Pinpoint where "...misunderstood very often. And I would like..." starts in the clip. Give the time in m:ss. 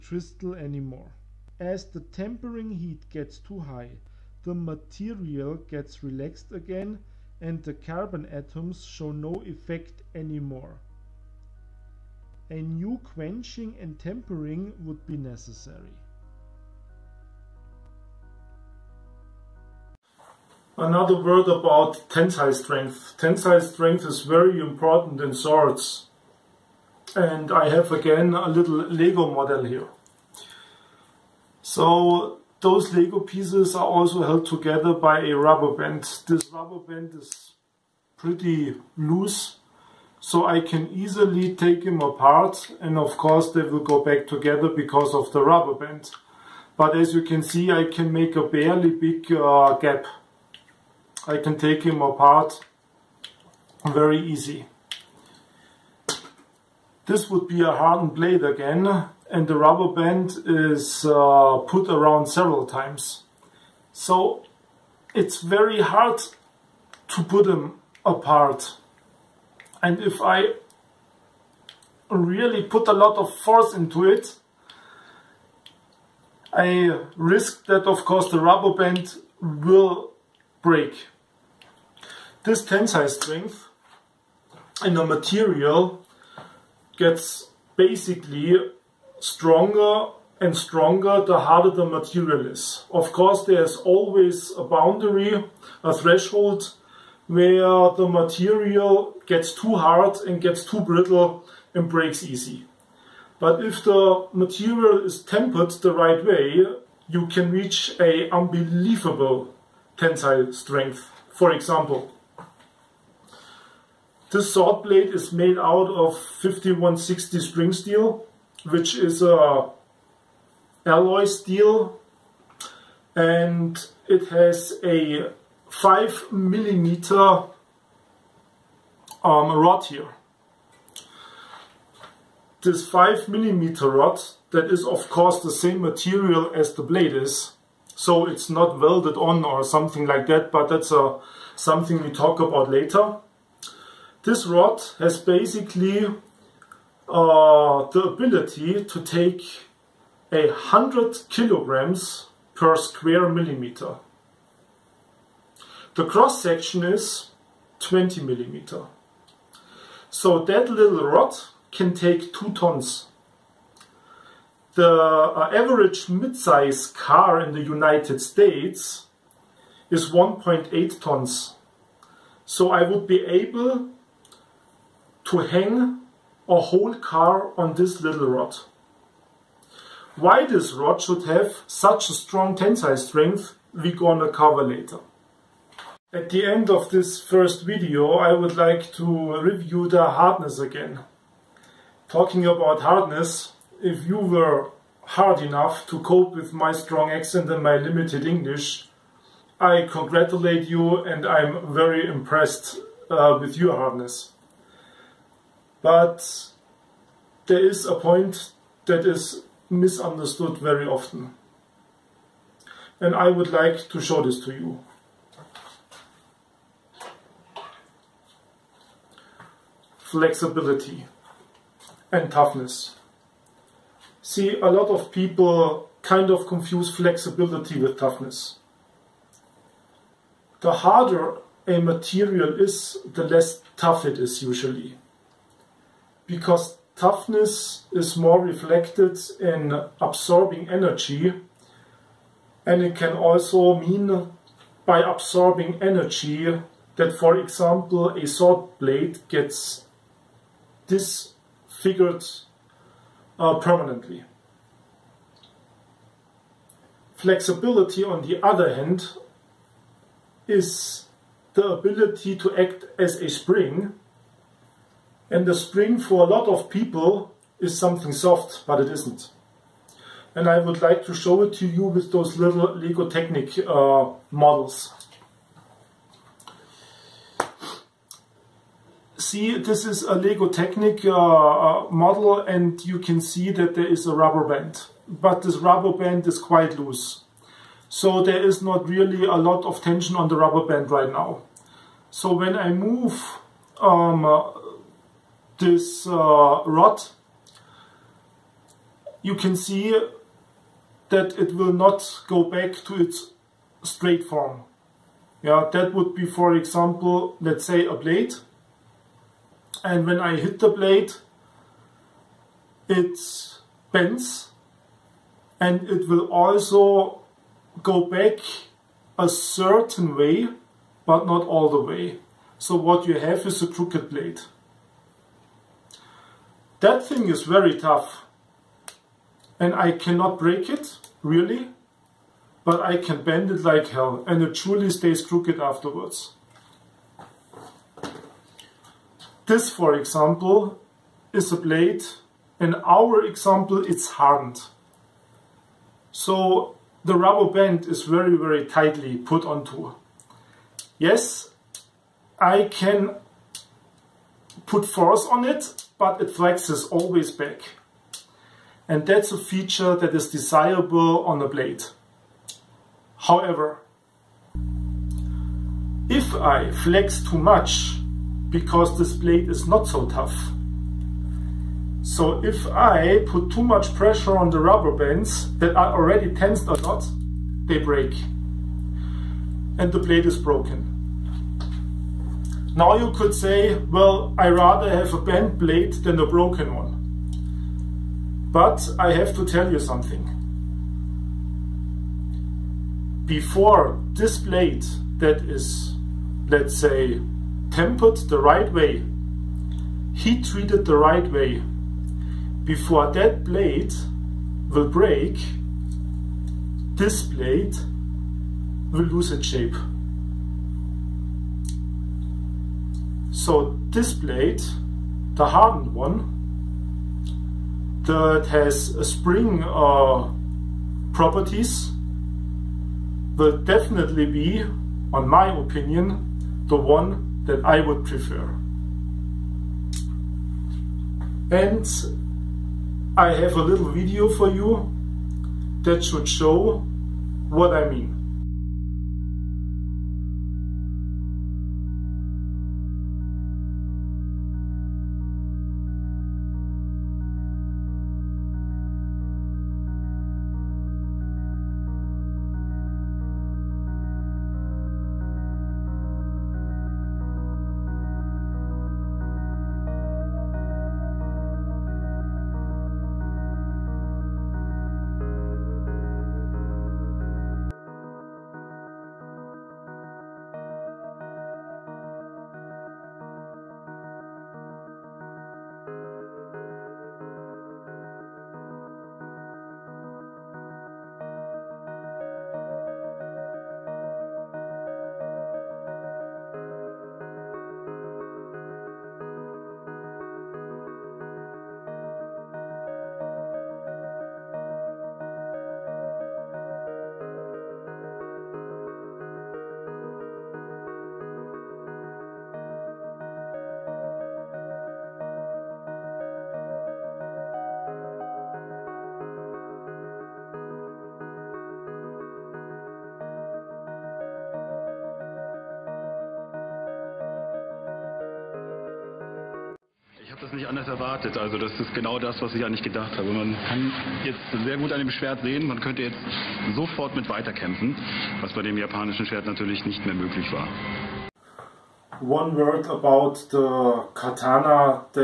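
3:29.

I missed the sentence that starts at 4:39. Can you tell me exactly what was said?
See, this is a Lego Technic uh, uh, model and you can see that there is a rubber band.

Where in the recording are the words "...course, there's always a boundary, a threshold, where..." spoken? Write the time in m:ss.
1:33.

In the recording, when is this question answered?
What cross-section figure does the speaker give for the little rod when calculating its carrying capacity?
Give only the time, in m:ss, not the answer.
2:37.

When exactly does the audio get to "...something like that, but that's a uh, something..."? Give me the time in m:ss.
2:19.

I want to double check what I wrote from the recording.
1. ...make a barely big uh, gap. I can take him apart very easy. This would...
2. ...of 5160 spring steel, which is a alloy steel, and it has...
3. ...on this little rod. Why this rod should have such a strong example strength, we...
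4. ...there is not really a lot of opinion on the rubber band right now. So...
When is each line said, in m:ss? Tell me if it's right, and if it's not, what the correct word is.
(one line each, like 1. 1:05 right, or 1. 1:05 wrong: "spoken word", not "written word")
1. 0:48 right
2. 1:55 right
3. 2:57 wrong: "tensile", not "example"
4. 4:48 wrong: "tension", not "opinion".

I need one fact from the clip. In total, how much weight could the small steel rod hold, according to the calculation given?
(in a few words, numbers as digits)
2 tons.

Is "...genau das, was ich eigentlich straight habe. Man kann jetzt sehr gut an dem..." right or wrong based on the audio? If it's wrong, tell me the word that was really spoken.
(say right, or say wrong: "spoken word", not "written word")
wrong: "gedacht", not "straight".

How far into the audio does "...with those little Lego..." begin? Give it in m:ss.
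4:31.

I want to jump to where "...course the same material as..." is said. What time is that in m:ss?
2:15.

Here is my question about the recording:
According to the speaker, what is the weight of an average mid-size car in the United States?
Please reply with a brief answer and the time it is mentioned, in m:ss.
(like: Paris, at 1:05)
1.8 tons, at 2:50.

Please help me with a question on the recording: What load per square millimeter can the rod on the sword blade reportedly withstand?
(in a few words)
100 kilograms.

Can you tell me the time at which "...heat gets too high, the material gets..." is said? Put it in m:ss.
0:02.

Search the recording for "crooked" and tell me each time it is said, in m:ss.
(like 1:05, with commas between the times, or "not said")
5:23, 5:35.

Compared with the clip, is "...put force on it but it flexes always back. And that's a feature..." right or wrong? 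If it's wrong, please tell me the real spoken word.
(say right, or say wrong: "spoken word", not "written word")
right.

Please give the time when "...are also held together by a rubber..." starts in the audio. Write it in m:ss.
0:33.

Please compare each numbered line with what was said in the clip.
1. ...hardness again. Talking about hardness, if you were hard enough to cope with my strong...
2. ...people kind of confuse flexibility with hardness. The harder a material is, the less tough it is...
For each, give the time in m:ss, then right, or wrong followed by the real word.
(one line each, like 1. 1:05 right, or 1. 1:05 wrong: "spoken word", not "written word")
1. 3:10 right
2. 3:45 wrong: "toughness", not "hardness".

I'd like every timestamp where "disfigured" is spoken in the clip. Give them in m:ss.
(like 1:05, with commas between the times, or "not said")
4:10.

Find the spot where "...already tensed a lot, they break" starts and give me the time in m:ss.
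6:15.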